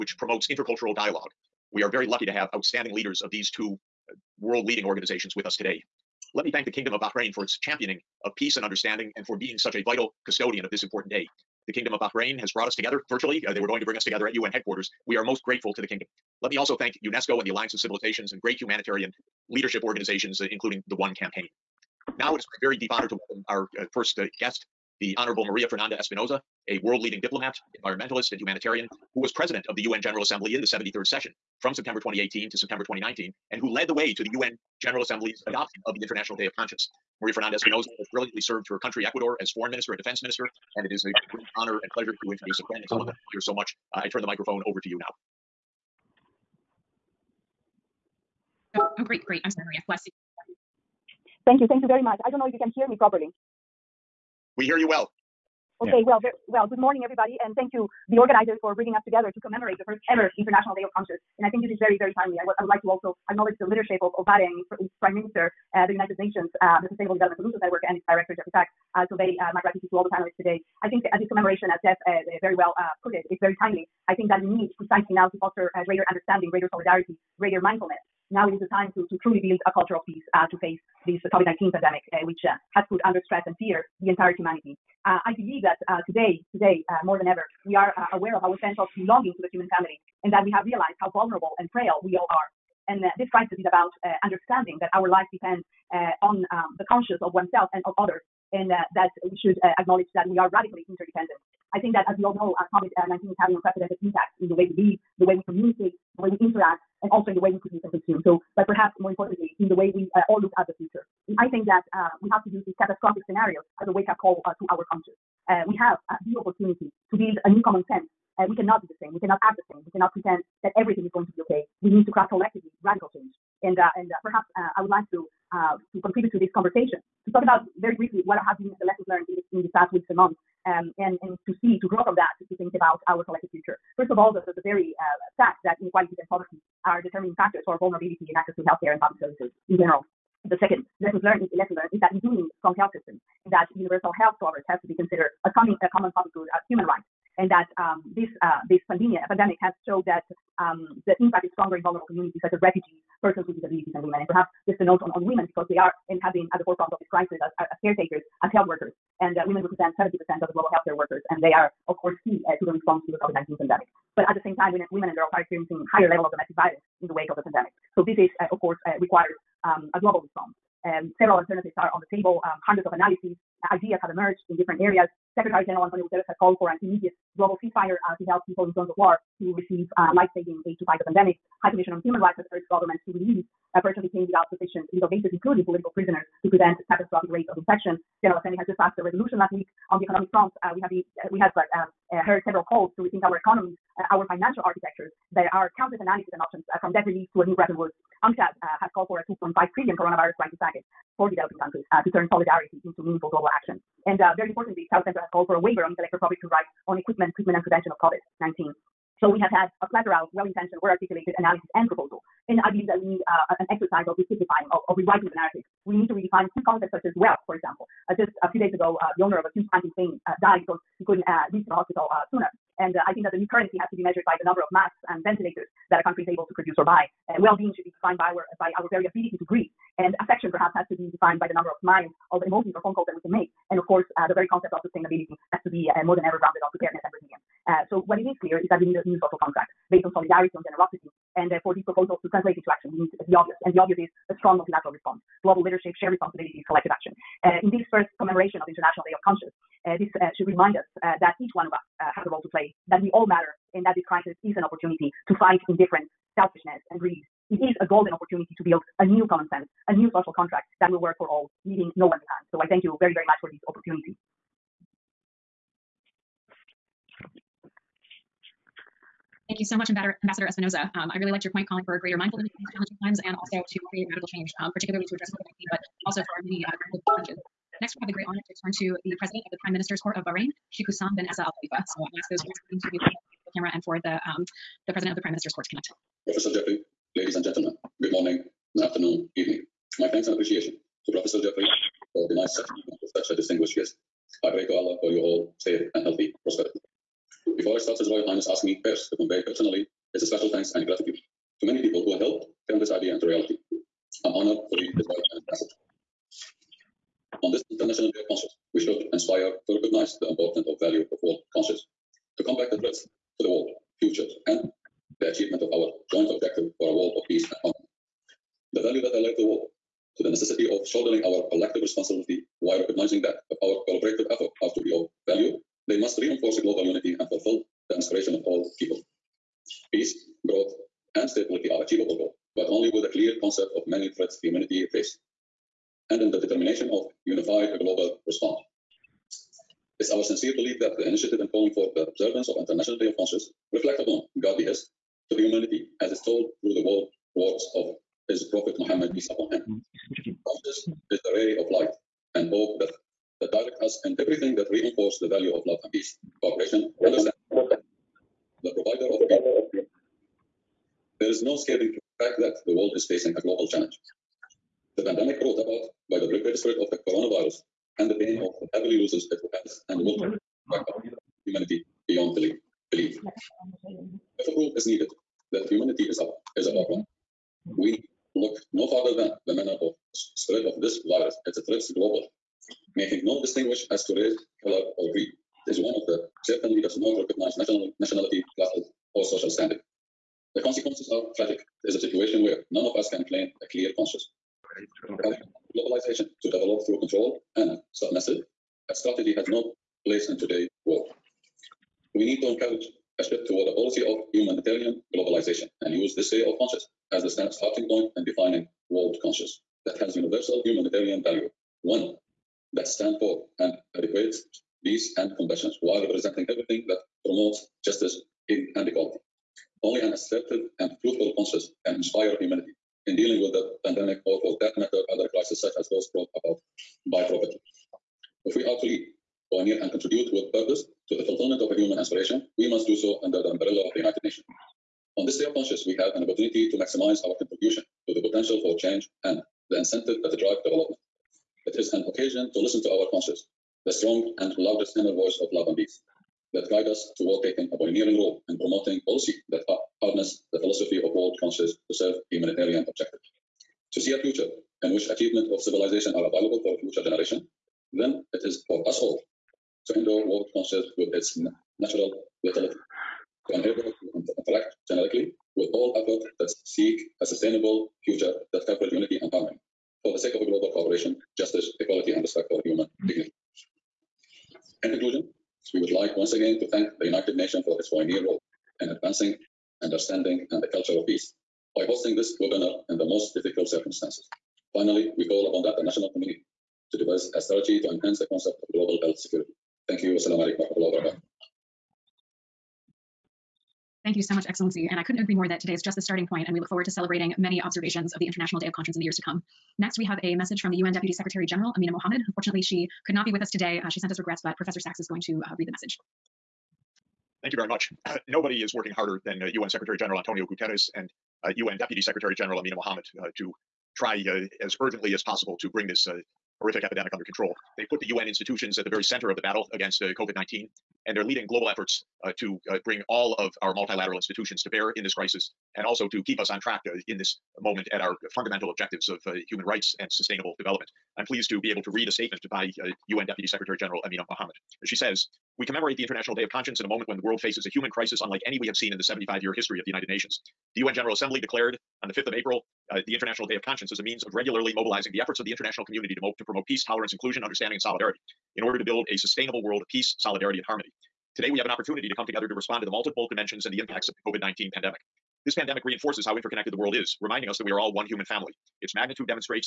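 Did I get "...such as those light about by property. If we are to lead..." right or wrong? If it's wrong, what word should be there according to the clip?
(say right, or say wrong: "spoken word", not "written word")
wrong: "brought", not "light".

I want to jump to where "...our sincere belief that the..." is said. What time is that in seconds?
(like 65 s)
340 s.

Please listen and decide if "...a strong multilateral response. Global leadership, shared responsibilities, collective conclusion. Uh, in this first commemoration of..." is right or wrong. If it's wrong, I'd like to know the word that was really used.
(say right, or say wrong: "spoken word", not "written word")
wrong: "action", not "conclusion".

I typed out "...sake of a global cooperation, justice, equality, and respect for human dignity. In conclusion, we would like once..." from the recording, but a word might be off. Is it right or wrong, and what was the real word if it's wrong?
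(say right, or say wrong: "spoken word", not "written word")
right.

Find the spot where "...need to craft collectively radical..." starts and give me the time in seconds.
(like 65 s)
121 s.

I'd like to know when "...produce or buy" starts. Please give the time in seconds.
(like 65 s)
226 s.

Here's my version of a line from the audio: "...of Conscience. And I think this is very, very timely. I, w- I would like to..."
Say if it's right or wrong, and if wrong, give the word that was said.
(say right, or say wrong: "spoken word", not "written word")
right.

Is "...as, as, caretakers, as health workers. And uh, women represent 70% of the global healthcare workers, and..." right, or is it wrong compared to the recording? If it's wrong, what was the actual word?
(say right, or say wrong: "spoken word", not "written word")
right.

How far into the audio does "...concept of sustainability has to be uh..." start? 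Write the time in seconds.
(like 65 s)
234 s.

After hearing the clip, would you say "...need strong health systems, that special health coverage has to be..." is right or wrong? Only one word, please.
wrong.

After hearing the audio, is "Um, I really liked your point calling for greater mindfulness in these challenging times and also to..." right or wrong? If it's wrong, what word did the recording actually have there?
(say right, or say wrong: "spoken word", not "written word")
right.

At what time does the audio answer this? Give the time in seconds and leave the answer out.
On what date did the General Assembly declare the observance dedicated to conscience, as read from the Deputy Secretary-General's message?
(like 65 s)
542 s.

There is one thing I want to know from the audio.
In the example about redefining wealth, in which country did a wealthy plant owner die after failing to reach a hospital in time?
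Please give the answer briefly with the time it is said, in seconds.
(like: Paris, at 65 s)
Spain, at 219 s.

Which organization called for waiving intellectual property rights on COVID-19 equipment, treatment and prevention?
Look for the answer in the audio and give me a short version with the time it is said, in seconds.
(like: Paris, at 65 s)
South Center, at 204 s.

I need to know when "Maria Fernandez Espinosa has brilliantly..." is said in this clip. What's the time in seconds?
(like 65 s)
37 s.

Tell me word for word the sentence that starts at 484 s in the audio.
Finally, we call upon the international community to devise a strategy to enhance the concept of global health security.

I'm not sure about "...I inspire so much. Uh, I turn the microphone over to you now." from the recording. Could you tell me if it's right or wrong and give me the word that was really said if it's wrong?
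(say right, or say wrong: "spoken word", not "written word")
wrong: "admire", not "inspire".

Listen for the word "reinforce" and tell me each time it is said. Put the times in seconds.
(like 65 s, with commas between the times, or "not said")
326 s, 354 s, 555 s.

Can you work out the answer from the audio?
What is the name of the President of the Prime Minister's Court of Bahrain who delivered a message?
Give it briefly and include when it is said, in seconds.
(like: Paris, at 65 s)
Sheikh Hussam bin Essa Al Khalifa, at 280 s.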